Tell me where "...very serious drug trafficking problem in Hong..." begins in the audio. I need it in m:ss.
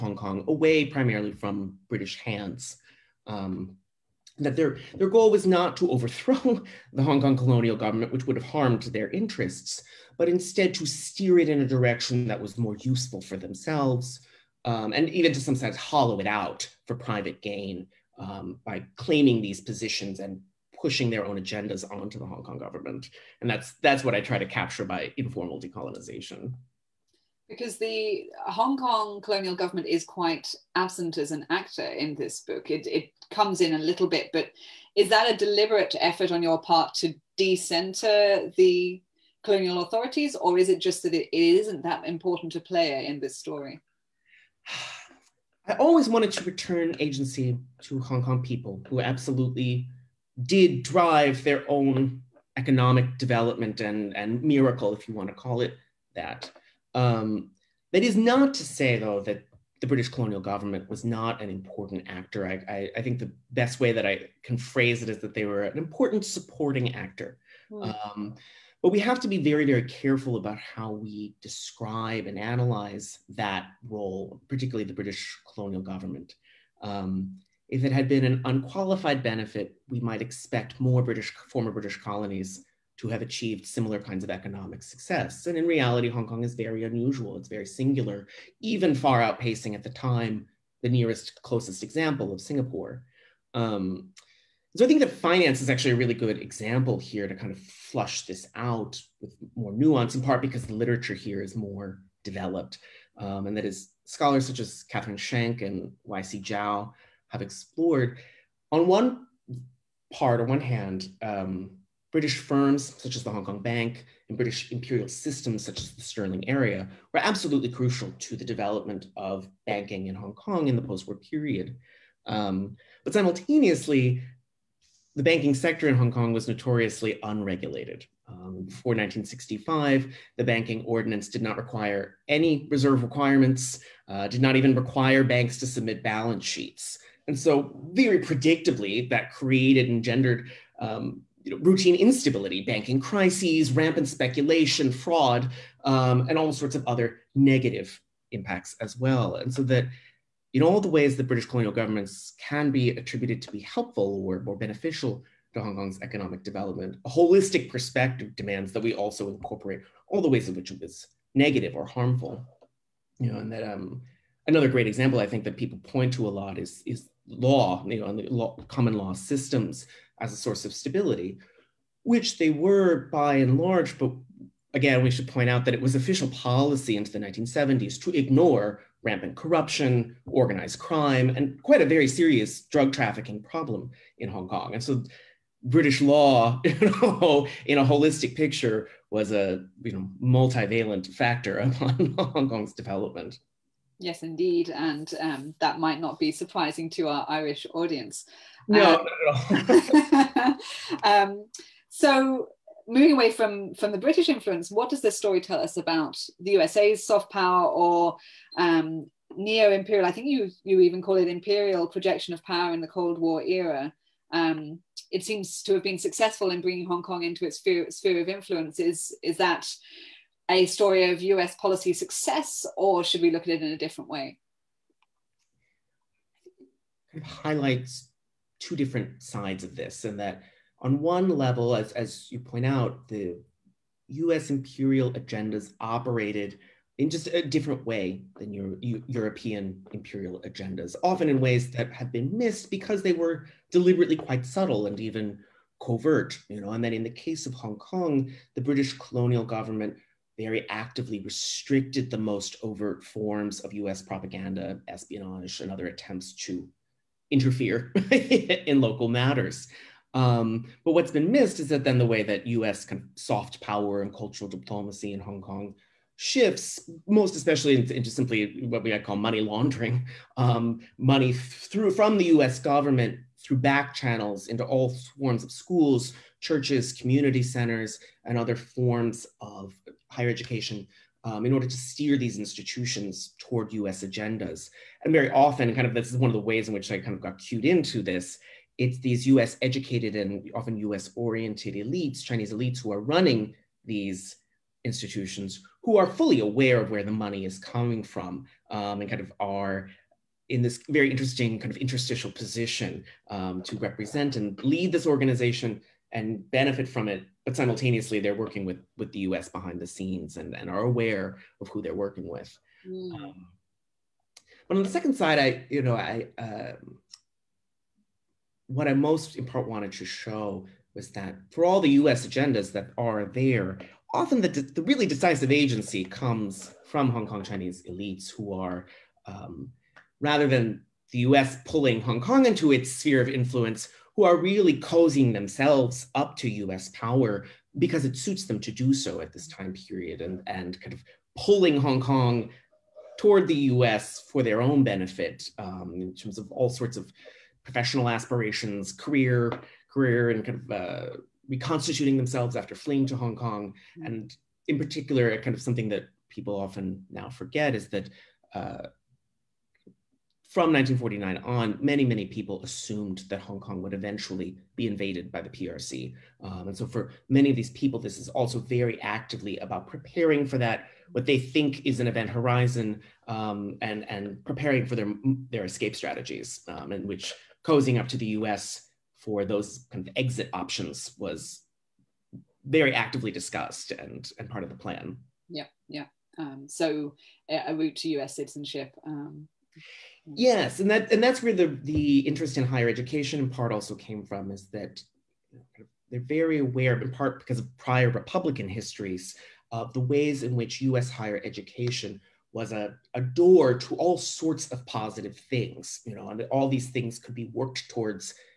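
3:01.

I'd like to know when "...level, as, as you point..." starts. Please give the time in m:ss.
3:51.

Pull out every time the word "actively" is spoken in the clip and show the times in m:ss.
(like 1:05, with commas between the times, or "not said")
4:10, 6:09, 6:22.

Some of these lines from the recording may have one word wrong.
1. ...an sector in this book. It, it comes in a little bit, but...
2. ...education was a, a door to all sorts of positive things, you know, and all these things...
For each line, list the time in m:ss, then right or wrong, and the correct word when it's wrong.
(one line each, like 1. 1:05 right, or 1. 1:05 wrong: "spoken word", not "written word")
1. 0:31 wrong: "actor", not "sector"
2. 6:41 right.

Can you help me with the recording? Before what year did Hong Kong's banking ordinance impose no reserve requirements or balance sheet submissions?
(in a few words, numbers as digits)
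1965.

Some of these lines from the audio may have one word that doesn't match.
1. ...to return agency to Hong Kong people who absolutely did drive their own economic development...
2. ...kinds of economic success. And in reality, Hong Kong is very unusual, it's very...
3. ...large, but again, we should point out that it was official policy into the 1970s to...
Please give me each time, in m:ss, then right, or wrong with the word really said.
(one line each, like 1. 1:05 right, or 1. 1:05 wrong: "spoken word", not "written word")
1. 0:46 right
2. 1:23 right
3. 2:53 right.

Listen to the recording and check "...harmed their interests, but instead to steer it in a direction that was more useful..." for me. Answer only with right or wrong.
right.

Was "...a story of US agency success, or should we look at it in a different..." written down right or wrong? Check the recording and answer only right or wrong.
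wrong.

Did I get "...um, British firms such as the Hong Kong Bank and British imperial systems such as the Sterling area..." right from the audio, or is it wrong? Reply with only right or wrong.
right.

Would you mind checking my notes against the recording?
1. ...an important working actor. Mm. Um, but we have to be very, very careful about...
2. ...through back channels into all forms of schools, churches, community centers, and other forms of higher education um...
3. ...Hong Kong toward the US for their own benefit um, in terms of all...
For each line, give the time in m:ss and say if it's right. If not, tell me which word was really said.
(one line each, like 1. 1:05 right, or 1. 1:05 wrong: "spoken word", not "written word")
1. 1:05 wrong: "supporting", not "working"
2. 4:33 right
3. 5:41 right.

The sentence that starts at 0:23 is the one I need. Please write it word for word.
And that's that's what I try to capture by informal decolonization.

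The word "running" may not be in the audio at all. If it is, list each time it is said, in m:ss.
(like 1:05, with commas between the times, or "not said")
4:53.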